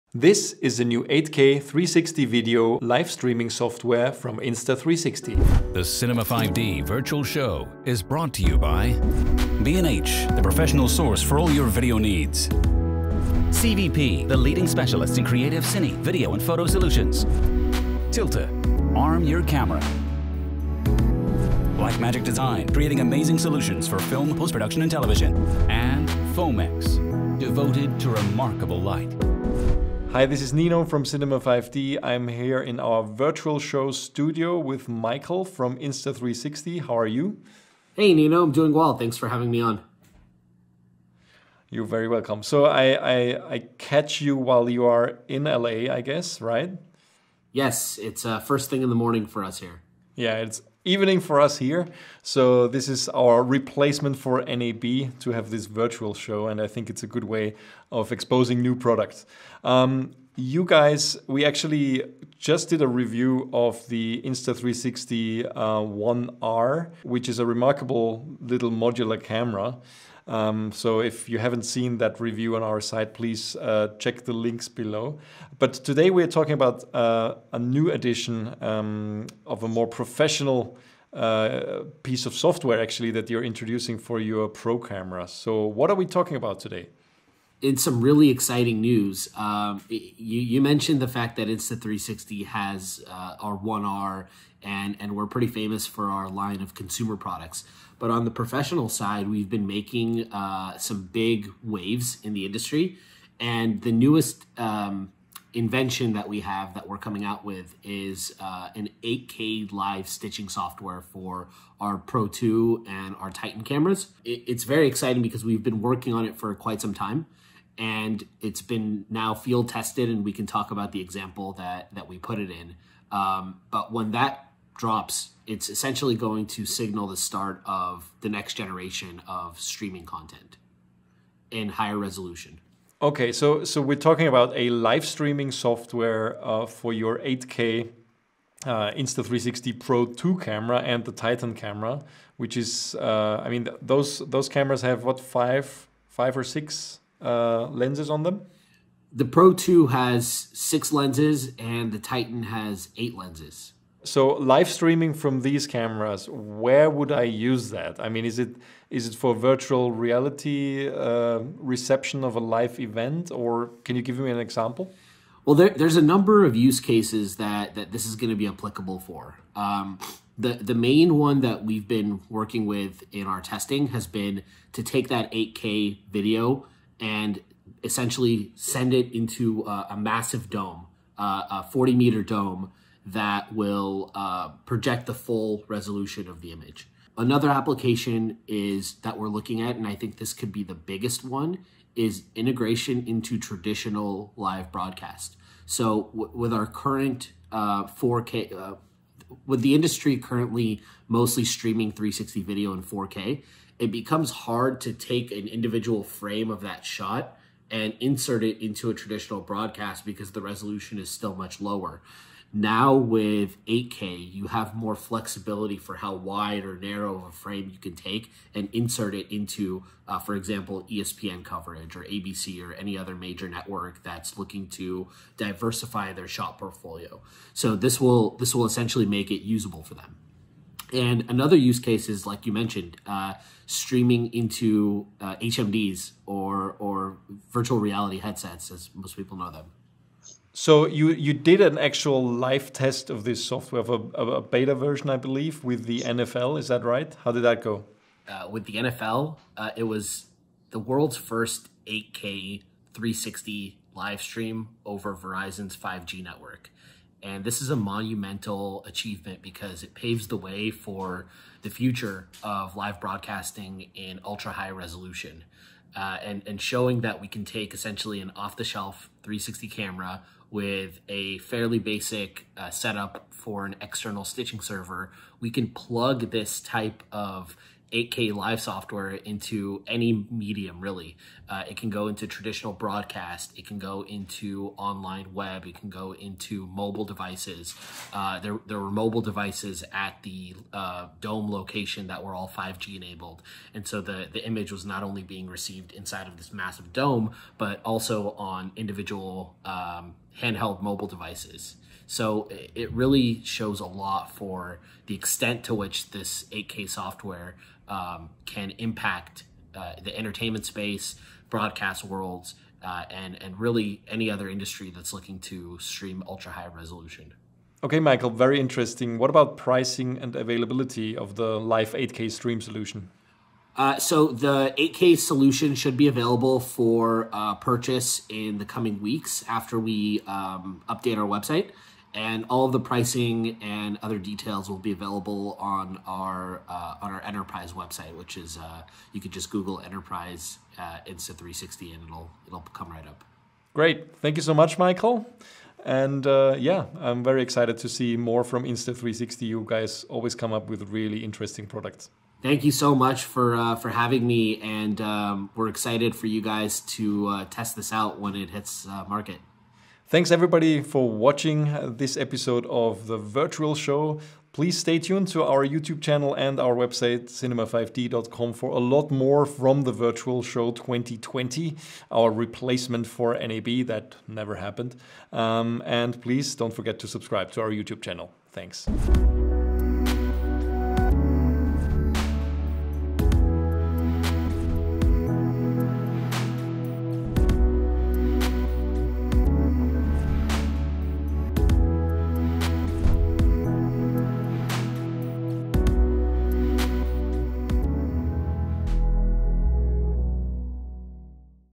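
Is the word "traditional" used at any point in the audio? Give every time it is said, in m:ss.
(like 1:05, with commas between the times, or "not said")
3:13, 3:28, 4:42.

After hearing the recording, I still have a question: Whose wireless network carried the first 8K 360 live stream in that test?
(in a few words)
Verizon.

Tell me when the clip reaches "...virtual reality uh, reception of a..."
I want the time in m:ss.
2:39.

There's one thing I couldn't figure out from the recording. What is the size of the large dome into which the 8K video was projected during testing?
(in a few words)
40 meters.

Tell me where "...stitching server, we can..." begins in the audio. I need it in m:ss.
4:34.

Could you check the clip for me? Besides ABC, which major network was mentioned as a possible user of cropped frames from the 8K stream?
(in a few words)
ESPN.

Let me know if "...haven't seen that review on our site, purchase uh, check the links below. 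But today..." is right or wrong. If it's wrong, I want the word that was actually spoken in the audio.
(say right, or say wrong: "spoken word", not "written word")
wrong: "please", not "purchase".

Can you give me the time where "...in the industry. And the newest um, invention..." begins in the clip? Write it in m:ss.
1:42.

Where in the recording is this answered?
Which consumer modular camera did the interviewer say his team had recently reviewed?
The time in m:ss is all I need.
1:04.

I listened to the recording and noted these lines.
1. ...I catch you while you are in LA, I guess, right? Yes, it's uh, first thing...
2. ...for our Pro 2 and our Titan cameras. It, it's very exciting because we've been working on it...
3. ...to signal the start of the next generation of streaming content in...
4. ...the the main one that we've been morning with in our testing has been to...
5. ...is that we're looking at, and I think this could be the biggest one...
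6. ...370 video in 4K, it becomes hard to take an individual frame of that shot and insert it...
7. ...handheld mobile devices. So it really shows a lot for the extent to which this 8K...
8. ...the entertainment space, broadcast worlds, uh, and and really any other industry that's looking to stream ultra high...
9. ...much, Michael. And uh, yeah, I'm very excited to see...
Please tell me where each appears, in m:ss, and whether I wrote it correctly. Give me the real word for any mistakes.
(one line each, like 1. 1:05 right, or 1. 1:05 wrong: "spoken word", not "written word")
1. 0:43 right
2. 1:51 right
3. 2:06 right
4. 2:50 wrong: "working", not "morning"
5. 3:08 right
6. 3:21 wrong: "360", not "370"
7. 5:00 right
8. 5:10 right
9. 5:44 right.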